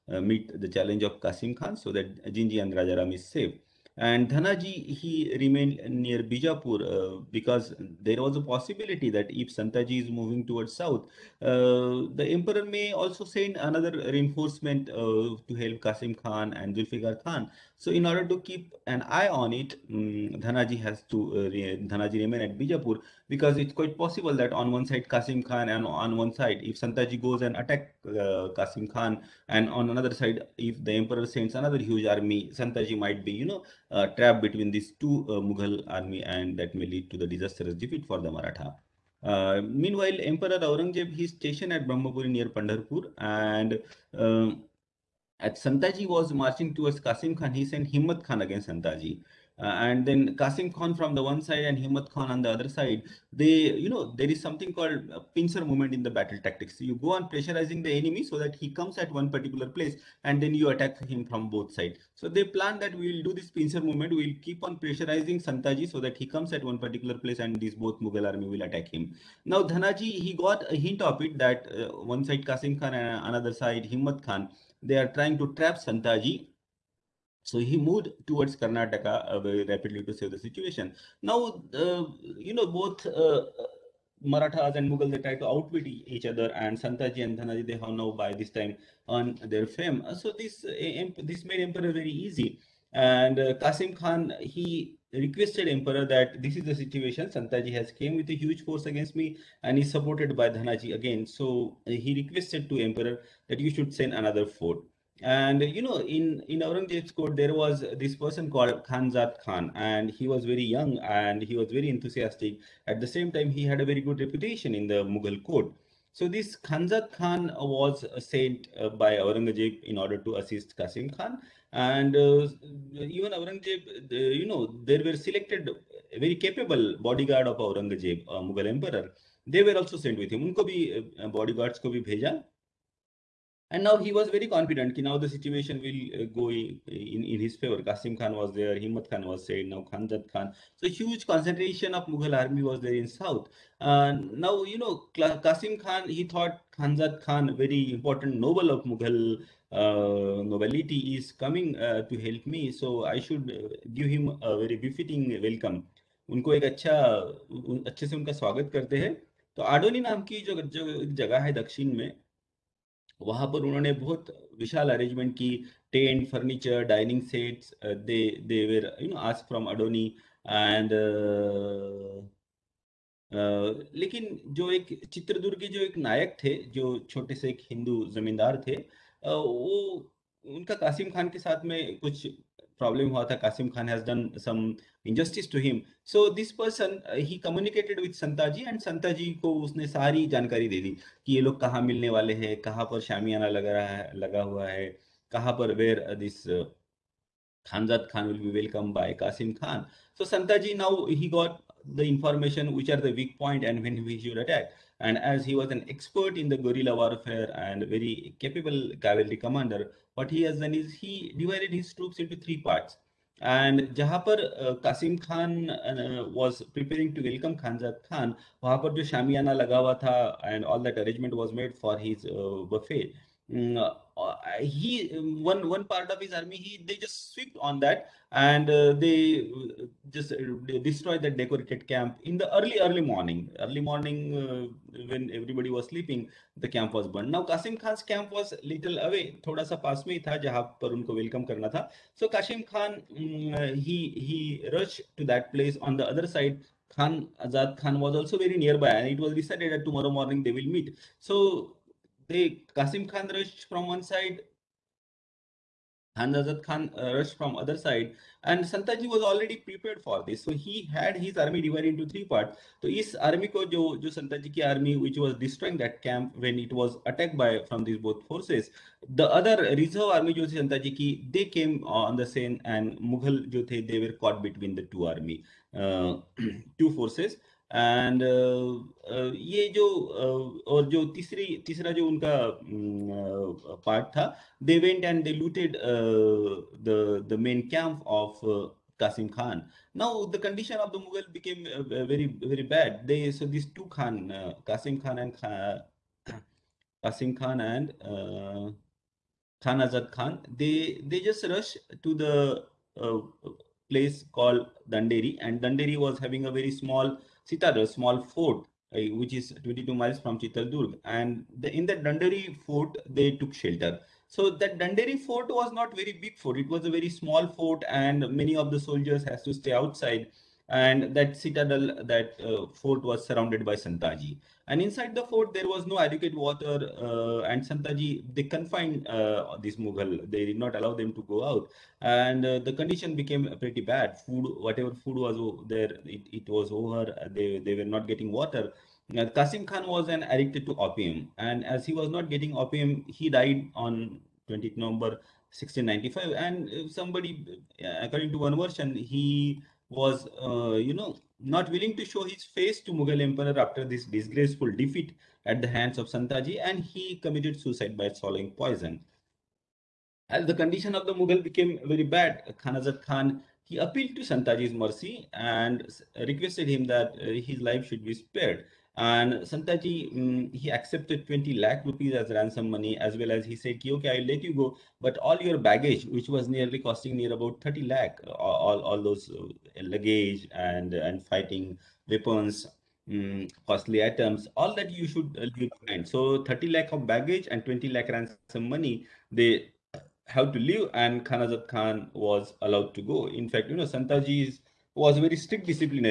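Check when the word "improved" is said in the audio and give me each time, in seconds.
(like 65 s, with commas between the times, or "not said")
not said.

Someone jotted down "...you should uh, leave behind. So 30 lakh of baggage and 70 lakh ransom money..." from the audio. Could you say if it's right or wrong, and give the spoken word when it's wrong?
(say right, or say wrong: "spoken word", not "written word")
wrong: "20", not "70".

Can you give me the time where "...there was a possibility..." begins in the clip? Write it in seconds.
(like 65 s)
8 s.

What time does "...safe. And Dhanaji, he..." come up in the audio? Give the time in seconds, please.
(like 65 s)
3 s.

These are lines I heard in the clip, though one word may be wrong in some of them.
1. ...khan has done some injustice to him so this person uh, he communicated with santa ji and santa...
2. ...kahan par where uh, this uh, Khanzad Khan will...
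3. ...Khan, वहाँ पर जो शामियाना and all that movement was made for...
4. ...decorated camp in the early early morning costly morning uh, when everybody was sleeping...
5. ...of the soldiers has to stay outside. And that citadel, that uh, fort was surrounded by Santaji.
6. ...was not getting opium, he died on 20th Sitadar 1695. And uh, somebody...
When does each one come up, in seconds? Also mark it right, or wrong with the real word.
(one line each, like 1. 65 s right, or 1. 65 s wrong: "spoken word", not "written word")
1. 183 s right
2. 195 s right
3. 218 s wrong: "arrangement", not "movement"
4. 231 s wrong: "early", not "costly"
5. 318 s right
6. 341 s wrong: "November", not "Sitadar".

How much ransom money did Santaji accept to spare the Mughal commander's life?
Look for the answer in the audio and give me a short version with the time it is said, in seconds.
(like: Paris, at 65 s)
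20 lakh rupees, at 371 s.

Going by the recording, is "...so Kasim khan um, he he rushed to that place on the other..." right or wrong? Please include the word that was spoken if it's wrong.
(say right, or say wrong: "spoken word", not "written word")
right.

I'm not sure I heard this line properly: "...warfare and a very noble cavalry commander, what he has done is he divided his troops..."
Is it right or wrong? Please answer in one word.
wrong.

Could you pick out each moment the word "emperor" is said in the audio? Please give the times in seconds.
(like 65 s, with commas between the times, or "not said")
12 s, 30 s, 40 s, 91 s, 95 s, 102 s, 128 s, 353 s.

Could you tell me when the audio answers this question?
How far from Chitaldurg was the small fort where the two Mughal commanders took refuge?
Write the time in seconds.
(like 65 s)
309 s.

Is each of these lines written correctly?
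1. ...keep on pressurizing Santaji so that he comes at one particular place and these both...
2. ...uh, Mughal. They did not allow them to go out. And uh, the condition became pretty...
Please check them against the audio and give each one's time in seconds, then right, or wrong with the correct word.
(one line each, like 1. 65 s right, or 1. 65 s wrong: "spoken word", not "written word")
1. 64 s right
2. 329 s right.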